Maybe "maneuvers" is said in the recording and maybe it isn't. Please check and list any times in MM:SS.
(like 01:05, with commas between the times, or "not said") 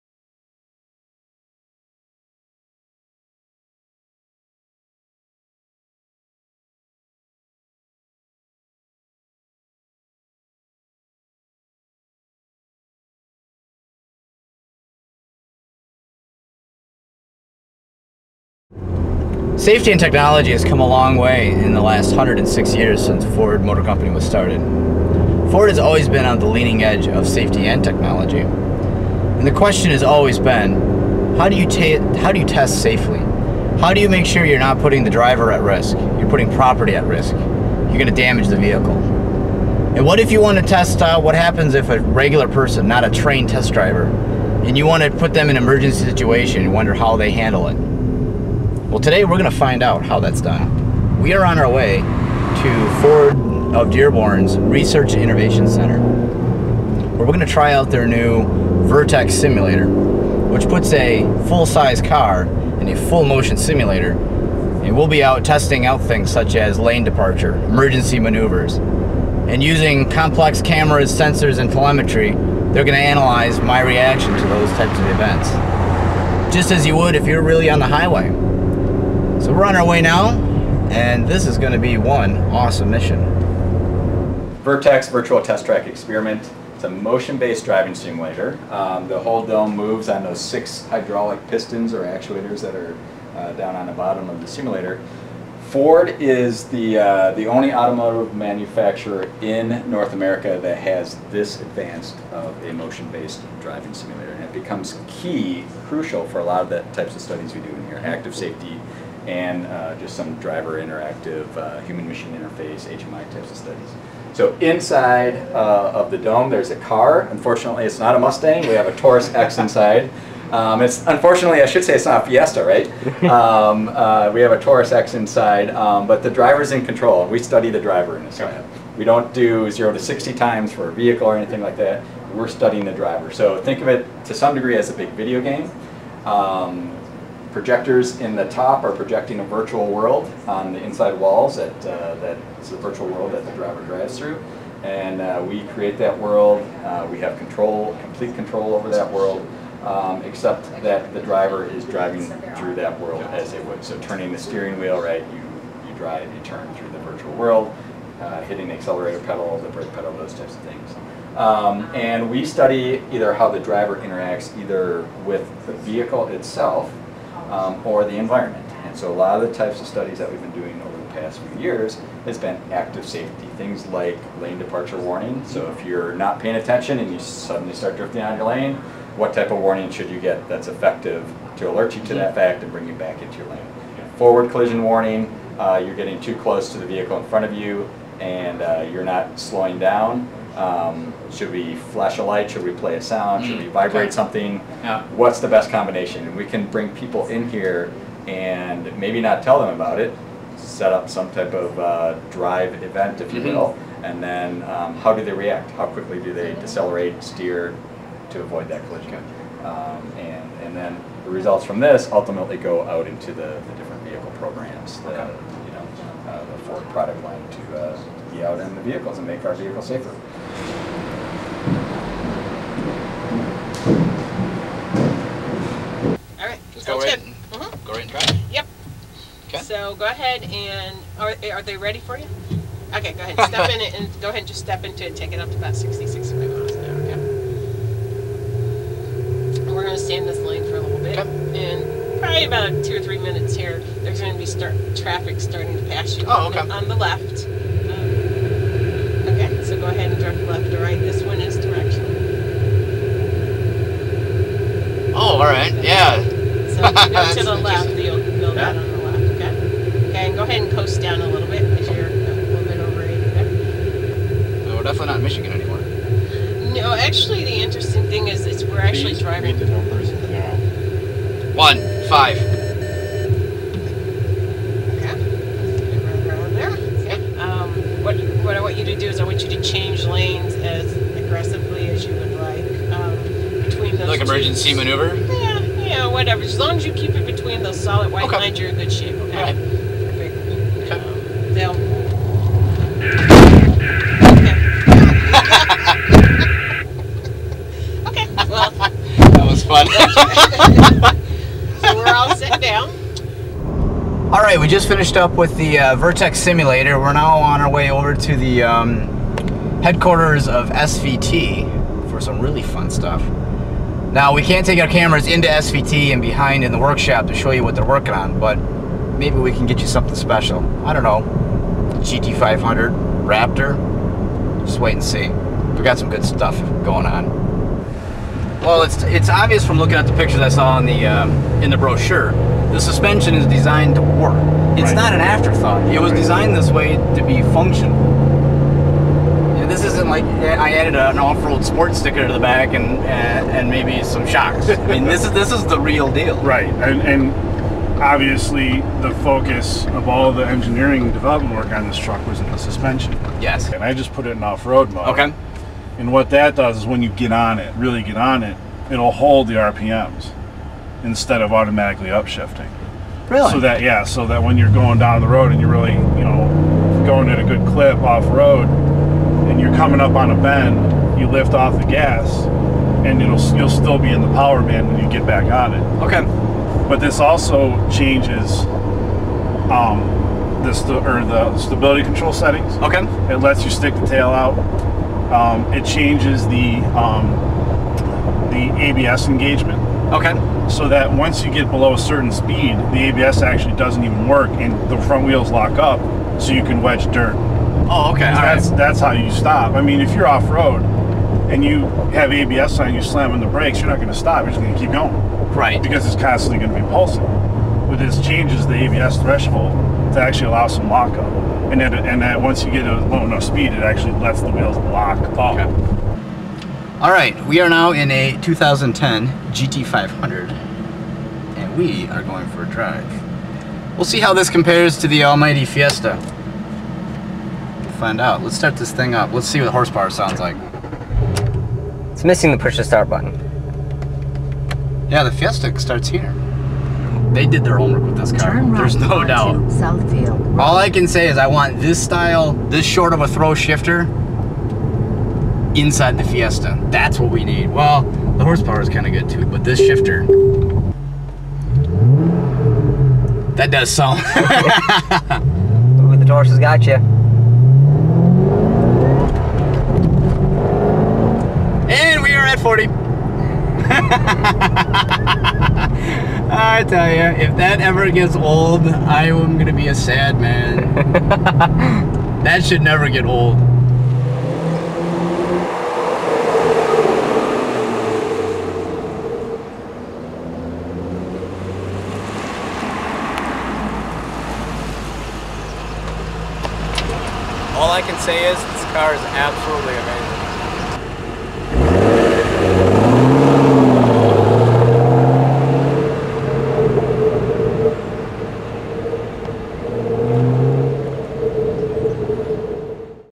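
01:08, 04:44.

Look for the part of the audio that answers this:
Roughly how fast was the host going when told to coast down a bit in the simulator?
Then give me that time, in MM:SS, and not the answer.
04:22.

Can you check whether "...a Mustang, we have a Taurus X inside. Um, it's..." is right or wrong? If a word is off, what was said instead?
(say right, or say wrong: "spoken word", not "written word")
right.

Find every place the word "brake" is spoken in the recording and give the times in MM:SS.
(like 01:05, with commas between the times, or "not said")
02:39, 06:43.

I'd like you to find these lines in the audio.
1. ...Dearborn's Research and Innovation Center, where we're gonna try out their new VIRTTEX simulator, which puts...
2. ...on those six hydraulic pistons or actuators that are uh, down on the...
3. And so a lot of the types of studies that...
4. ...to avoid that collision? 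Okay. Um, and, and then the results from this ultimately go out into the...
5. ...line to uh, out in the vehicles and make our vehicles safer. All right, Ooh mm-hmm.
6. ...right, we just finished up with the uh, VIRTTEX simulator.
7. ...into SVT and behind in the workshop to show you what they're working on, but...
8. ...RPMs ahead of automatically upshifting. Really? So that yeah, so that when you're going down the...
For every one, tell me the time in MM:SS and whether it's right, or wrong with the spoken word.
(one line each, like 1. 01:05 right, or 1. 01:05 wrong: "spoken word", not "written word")
1. 00:53 right
2. 01:30 right
3. 02:48 right
4. 03:28 right
5. 03:37 wrong: "Just", not "Ooh"
6. 05:04 right
7. 05:15 right
8. 05:59 wrong: "instead", not "ahead".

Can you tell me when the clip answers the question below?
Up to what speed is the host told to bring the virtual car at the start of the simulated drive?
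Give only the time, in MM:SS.
03:55.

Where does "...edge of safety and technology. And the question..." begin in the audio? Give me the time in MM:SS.
00:26.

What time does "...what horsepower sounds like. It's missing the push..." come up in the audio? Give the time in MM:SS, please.
07:09.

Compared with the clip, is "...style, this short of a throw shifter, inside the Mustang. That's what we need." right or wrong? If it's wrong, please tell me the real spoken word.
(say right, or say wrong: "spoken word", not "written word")
wrong: "Fiesta", not "Mustang".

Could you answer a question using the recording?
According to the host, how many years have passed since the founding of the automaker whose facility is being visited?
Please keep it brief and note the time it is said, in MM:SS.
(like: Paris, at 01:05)
106, at 00:22.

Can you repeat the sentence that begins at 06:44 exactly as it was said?
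You're just going to keep going.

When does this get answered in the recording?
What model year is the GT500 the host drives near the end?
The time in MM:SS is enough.
06:58.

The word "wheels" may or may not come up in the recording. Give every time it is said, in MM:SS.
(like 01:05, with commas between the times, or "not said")
02:34, 06:35, 06:54.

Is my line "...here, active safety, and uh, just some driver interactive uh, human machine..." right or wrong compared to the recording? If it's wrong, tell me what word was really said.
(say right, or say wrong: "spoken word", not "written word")
right.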